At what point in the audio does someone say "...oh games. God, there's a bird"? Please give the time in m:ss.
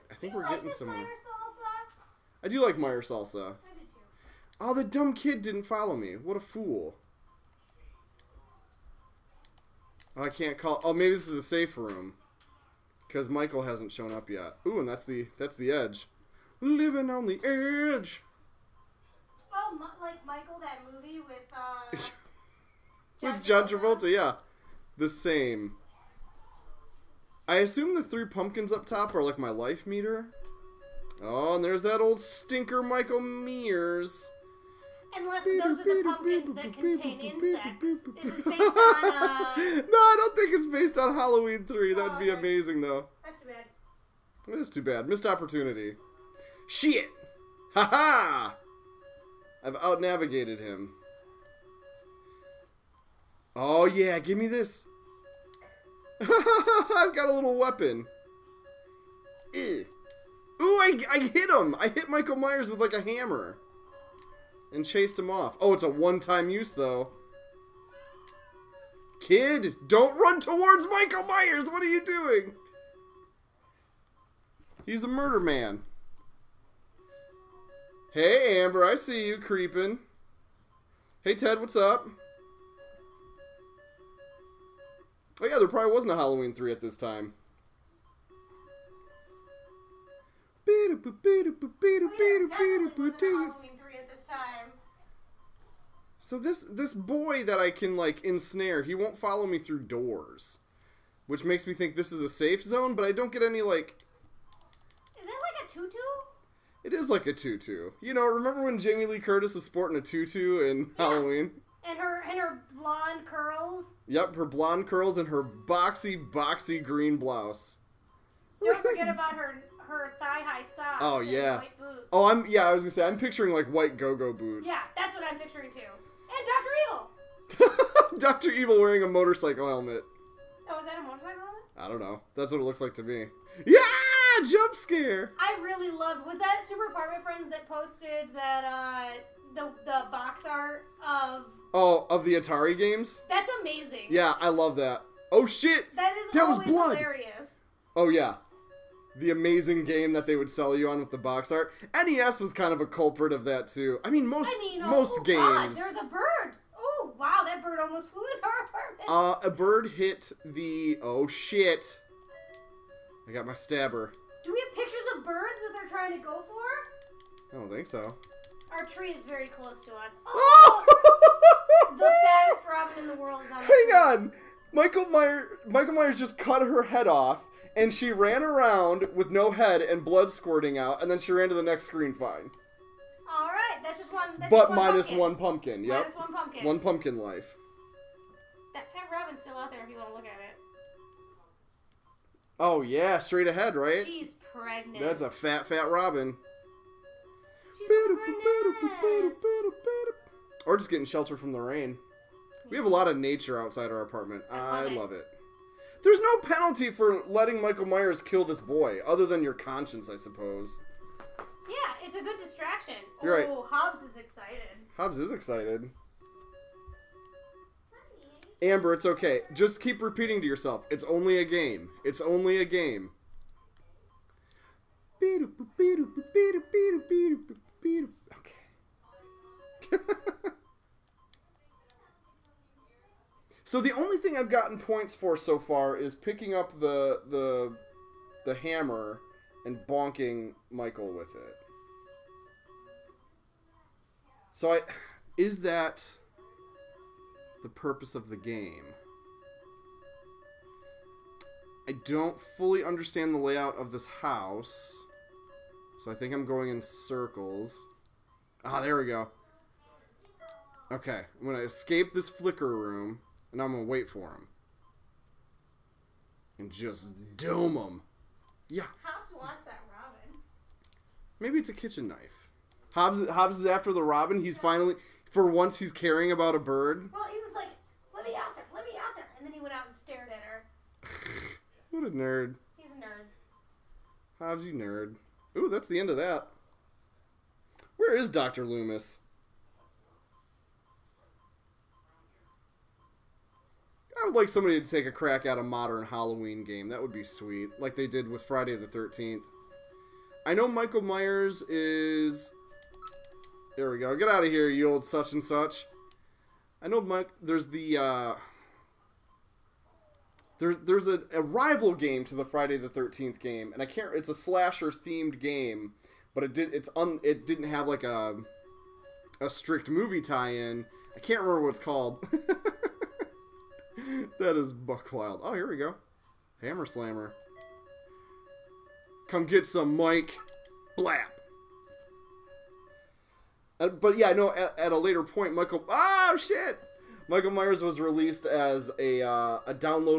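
2:35.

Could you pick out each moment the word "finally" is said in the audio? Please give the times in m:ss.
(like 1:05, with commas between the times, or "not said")
4:34.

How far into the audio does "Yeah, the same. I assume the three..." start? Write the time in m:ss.
0:24.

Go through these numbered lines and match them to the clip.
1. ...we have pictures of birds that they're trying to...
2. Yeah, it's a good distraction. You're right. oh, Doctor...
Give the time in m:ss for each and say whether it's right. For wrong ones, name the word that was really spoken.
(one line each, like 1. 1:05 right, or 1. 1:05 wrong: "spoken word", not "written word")
1. 2:44 right
2. 3:31 wrong: "Hobbs", not "Doctor".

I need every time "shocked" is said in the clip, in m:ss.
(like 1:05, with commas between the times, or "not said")
not said.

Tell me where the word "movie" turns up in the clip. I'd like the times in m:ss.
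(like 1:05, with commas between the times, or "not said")
0:20, 5:19.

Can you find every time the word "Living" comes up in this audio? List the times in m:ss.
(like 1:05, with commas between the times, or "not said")
0:16.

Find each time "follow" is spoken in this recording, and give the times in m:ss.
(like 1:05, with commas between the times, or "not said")
0:05, 1:39.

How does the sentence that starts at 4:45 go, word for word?
Ooh, that's the end of that.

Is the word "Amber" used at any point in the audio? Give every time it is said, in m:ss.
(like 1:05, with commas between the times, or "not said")
1:18, 3:38.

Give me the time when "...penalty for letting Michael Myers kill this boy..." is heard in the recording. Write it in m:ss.
3:26.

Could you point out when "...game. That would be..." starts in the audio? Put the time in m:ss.
4:56.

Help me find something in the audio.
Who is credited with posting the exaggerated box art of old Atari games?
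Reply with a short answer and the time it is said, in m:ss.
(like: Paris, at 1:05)
Super Apartment Friends, at 2:16.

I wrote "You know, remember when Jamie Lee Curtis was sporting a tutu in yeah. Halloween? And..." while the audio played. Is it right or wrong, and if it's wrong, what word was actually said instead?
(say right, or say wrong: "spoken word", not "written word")
right.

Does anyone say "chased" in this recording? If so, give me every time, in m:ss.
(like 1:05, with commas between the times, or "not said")
1:04.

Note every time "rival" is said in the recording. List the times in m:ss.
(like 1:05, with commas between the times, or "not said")
5:11.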